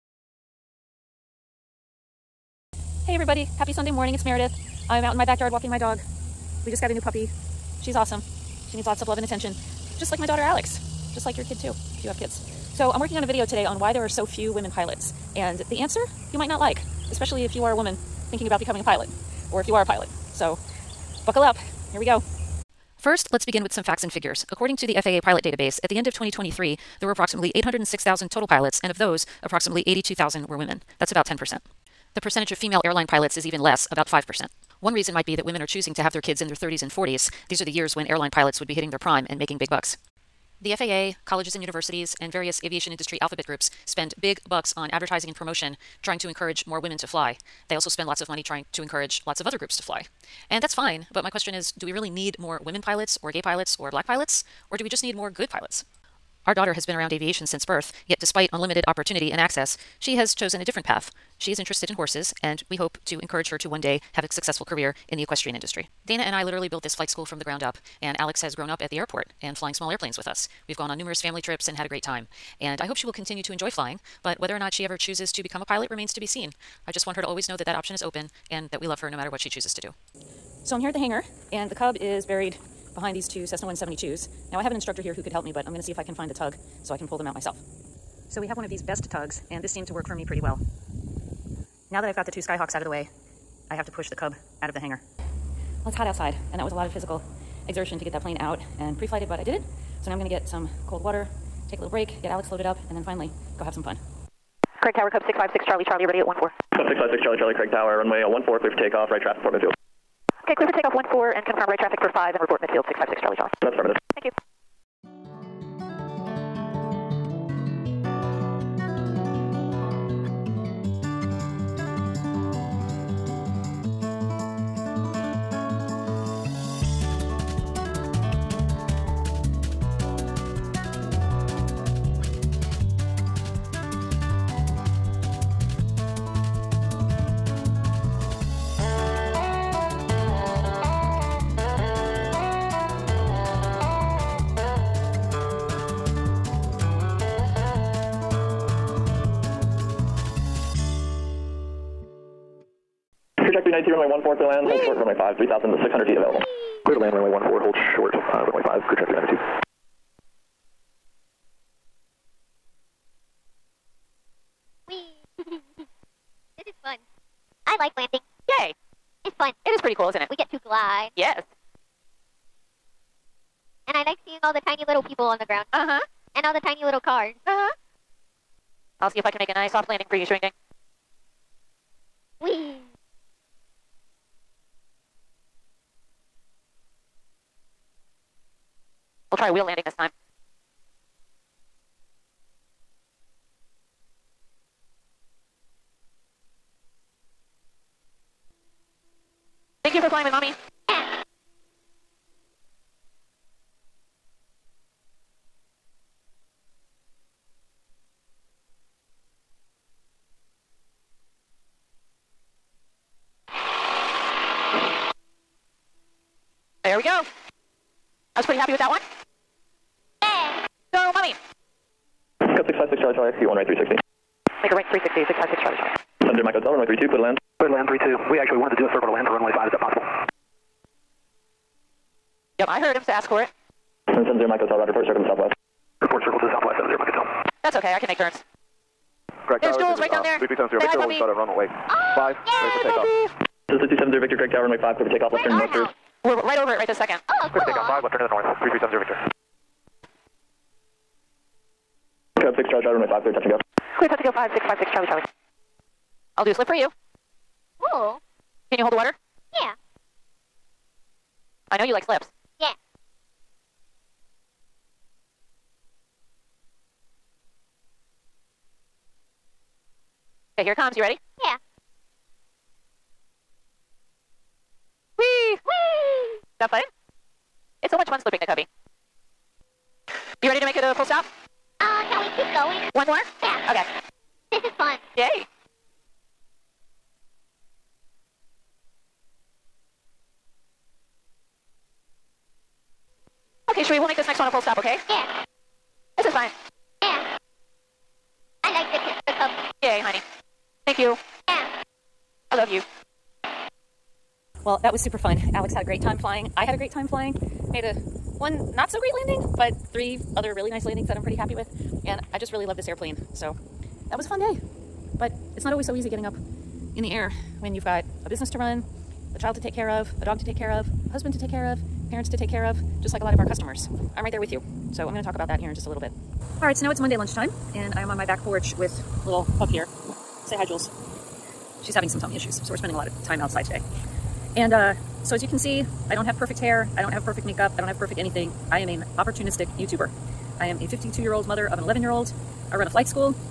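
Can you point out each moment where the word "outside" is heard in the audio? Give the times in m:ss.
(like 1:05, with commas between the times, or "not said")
1:36, 5:33.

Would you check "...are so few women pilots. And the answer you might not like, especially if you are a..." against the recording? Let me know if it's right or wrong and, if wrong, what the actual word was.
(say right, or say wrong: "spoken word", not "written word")
right.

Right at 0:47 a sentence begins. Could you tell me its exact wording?
They also spend lots of money trying to encourage lots of other groups to fly.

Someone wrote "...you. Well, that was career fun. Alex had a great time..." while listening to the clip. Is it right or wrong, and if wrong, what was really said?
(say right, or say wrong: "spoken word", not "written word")
wrong: "super", not "career".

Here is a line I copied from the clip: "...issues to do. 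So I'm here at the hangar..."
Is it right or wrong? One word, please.
wrong.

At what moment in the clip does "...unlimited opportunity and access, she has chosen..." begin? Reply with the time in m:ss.
0:58.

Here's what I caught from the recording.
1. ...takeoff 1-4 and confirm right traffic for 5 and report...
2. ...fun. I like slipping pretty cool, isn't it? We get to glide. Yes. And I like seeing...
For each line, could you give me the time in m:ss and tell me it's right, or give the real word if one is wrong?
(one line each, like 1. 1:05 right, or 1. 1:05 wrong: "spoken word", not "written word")
1. 1:50 right
2. 2:46 wrong: "landing", not "slipping".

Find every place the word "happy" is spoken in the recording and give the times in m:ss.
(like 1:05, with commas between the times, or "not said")
0:03, 3:38, 5:11.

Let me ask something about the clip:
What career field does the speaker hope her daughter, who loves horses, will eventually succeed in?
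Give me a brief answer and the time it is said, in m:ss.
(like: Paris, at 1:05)
equestrian industry, at 1:05.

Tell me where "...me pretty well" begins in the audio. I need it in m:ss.
1:30.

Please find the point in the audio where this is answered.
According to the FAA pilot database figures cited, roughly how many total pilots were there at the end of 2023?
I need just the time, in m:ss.
0:27.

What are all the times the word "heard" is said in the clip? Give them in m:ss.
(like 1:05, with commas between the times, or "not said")
3:52.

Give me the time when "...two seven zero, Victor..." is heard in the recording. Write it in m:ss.
4:03.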